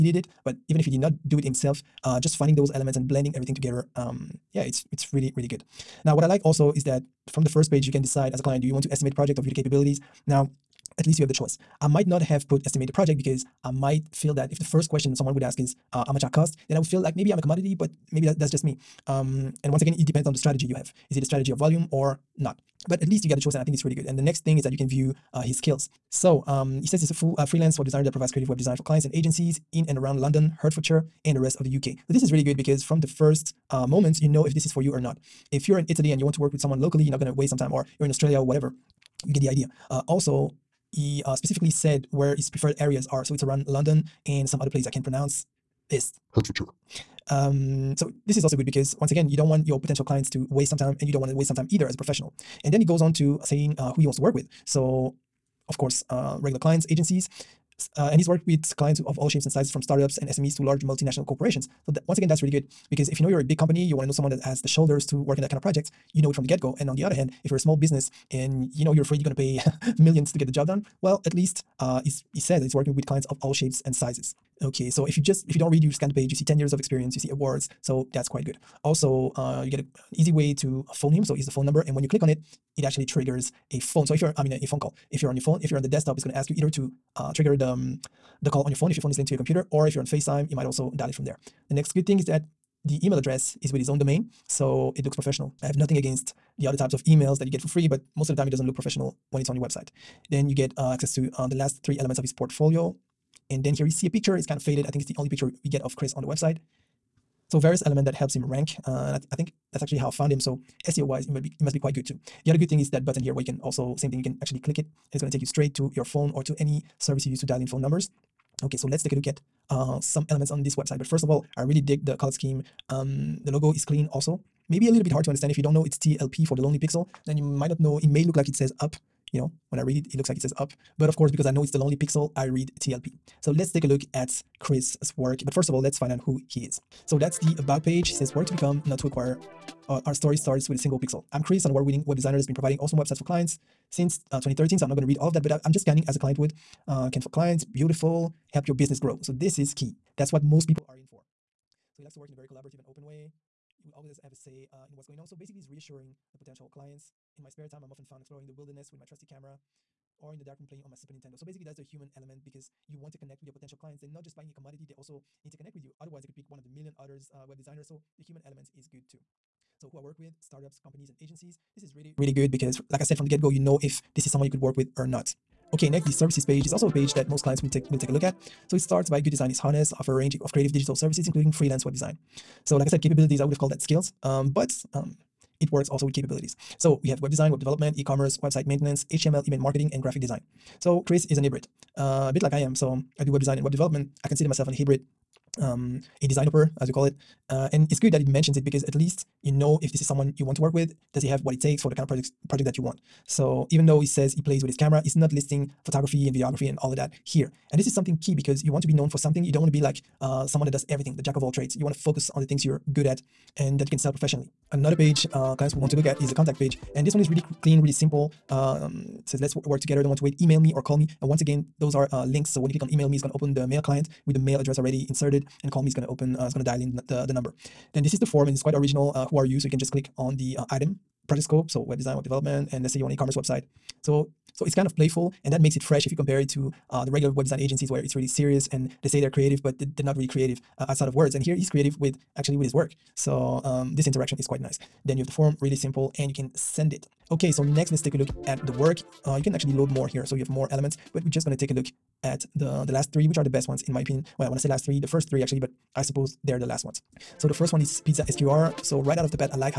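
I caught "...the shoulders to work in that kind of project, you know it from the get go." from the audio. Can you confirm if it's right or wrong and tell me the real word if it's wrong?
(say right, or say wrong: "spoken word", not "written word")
right.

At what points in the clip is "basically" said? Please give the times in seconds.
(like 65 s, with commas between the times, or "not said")
155 s, 161 s.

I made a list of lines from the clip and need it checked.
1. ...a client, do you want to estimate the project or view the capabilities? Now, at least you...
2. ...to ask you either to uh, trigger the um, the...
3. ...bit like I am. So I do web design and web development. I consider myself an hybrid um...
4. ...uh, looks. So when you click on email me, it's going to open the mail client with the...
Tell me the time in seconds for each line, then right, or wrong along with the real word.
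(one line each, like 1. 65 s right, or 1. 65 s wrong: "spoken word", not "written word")
1. 8 s right
2. 86 s right
3. 192 s right
4. 222 s wrong: "links", not "looks".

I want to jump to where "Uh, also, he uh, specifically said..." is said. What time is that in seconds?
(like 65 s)
39 s.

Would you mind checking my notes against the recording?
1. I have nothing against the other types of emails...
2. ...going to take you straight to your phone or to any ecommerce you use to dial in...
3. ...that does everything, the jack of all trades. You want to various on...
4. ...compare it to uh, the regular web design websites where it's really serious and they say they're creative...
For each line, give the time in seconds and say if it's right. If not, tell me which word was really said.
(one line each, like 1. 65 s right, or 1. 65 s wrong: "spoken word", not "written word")
1. 95 s right
2. 115 s wrong: "service", not "ecommerce"
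3. 210 s wrong: "focus", not "various"
4. 236 s wrong: "agencies", not "websites".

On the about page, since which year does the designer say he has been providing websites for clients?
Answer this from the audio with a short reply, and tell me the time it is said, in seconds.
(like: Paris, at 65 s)
2013, at 144 s.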